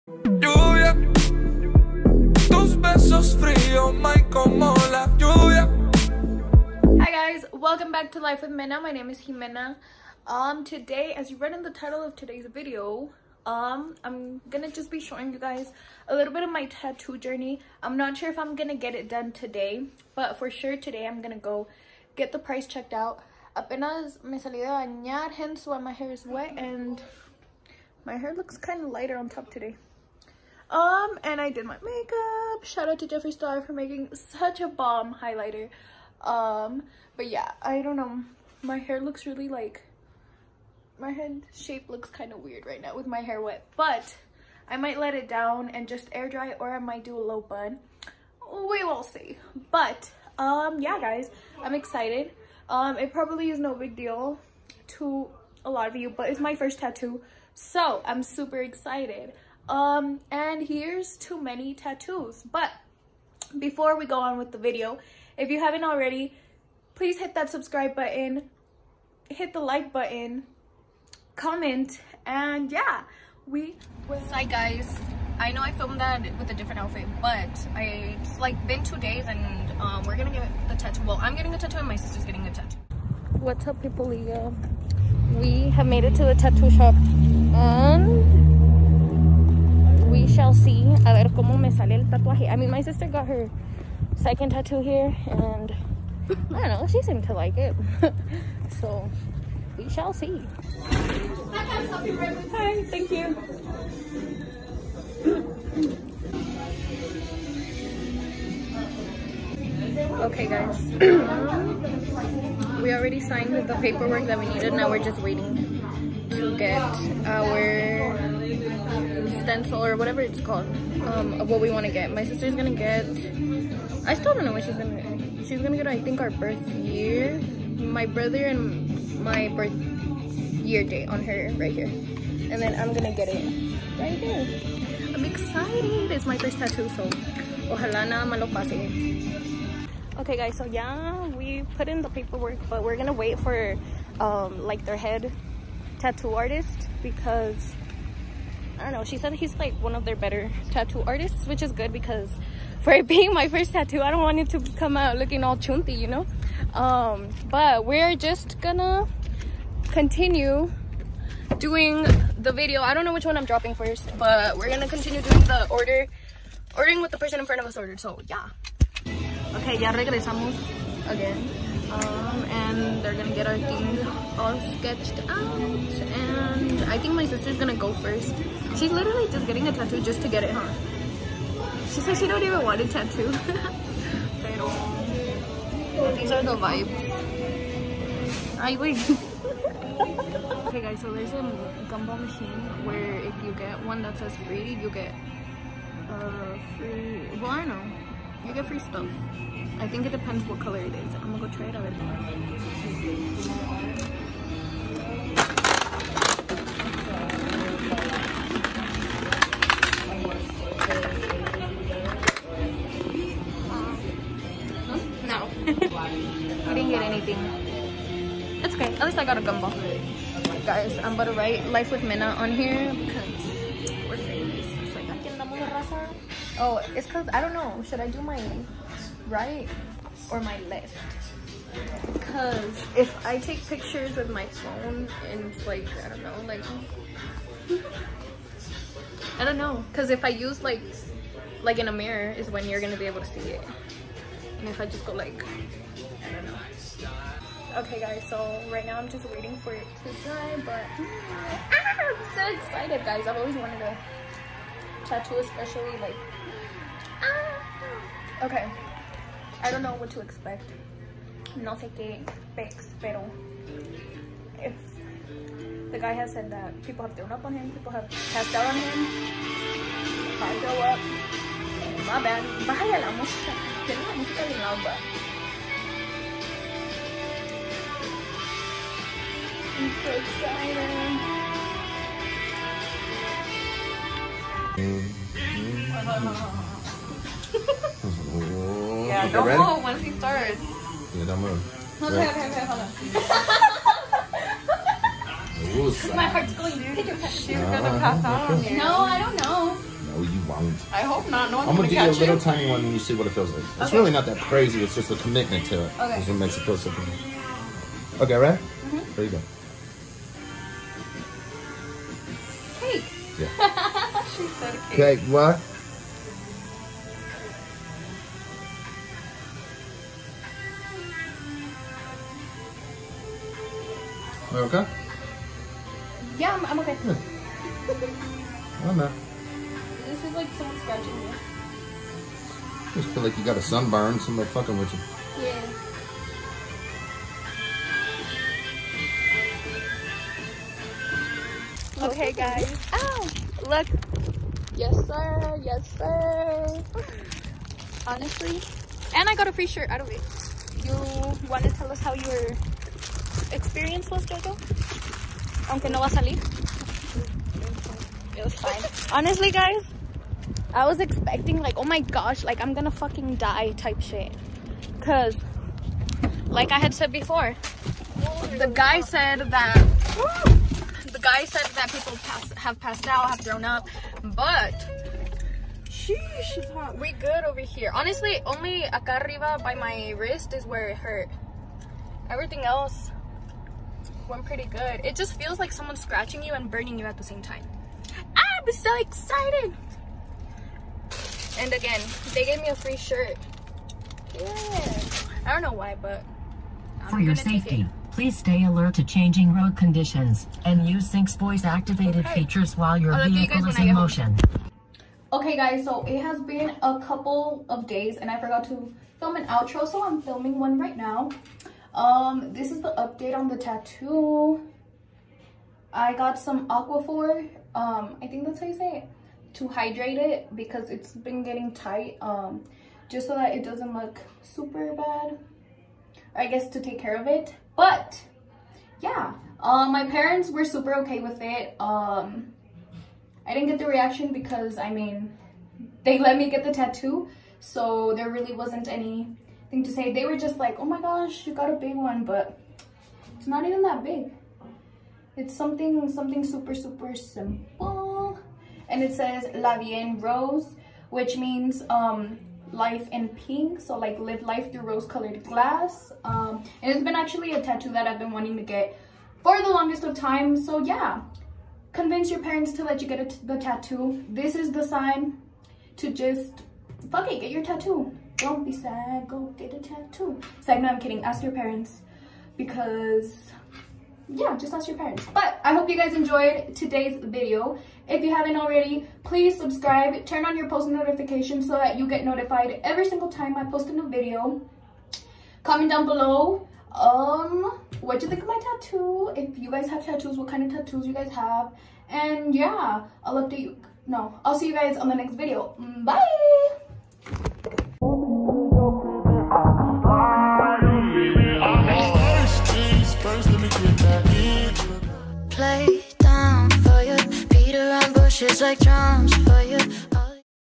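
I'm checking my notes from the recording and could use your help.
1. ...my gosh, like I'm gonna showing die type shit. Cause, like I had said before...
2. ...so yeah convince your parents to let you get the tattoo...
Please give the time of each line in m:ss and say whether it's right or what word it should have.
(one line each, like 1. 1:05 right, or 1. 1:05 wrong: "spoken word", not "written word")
1. 6:01 wrong: "fucking", not "showing"
2. 7:40 right.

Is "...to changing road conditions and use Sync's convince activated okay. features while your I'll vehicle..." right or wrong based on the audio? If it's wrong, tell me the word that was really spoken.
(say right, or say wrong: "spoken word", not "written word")
wrong: "voice", not "convince".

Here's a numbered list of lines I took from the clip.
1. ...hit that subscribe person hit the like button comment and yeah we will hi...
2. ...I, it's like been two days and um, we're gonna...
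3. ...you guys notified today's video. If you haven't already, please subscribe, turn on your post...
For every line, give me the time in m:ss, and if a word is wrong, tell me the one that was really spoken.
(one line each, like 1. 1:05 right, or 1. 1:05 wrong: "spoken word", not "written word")
1. 1:07 wrong: "button", not "person"
2. 1:17 right
3. 7:55 wrong: "enjoyed", not "notified".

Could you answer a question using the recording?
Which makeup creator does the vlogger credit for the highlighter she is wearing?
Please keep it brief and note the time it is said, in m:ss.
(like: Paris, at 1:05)
Jeffree Star, at 0:33.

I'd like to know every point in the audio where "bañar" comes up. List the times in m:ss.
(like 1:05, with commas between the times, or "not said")
0:24.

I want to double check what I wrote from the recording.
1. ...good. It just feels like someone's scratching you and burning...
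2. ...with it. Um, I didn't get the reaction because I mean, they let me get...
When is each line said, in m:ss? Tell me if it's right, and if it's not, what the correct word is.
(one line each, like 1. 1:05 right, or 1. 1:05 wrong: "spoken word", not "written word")
1. 6:24 right
2. 7:11 right.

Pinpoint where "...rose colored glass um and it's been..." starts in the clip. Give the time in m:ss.
7:34.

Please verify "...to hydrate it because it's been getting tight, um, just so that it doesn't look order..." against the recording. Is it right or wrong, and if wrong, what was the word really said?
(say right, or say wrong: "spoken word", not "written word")
wrong: "super", not "order".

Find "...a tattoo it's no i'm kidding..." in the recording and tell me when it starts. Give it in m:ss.
7:49.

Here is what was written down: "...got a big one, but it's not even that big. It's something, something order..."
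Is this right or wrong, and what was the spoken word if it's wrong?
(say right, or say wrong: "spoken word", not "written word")
wrong: "super", not "order".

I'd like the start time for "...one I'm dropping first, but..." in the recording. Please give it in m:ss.
2:43.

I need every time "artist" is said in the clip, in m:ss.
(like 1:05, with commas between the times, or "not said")
2:26, 2:31.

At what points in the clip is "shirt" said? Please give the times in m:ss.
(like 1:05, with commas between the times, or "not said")
5:49, 6:32.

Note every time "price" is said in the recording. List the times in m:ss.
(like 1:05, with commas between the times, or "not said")
0:22.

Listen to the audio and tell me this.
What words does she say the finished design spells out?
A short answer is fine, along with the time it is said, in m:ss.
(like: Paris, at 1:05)
La Rose, at 7:29.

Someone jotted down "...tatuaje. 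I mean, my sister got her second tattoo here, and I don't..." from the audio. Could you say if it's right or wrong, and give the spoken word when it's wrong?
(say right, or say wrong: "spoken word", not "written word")
right.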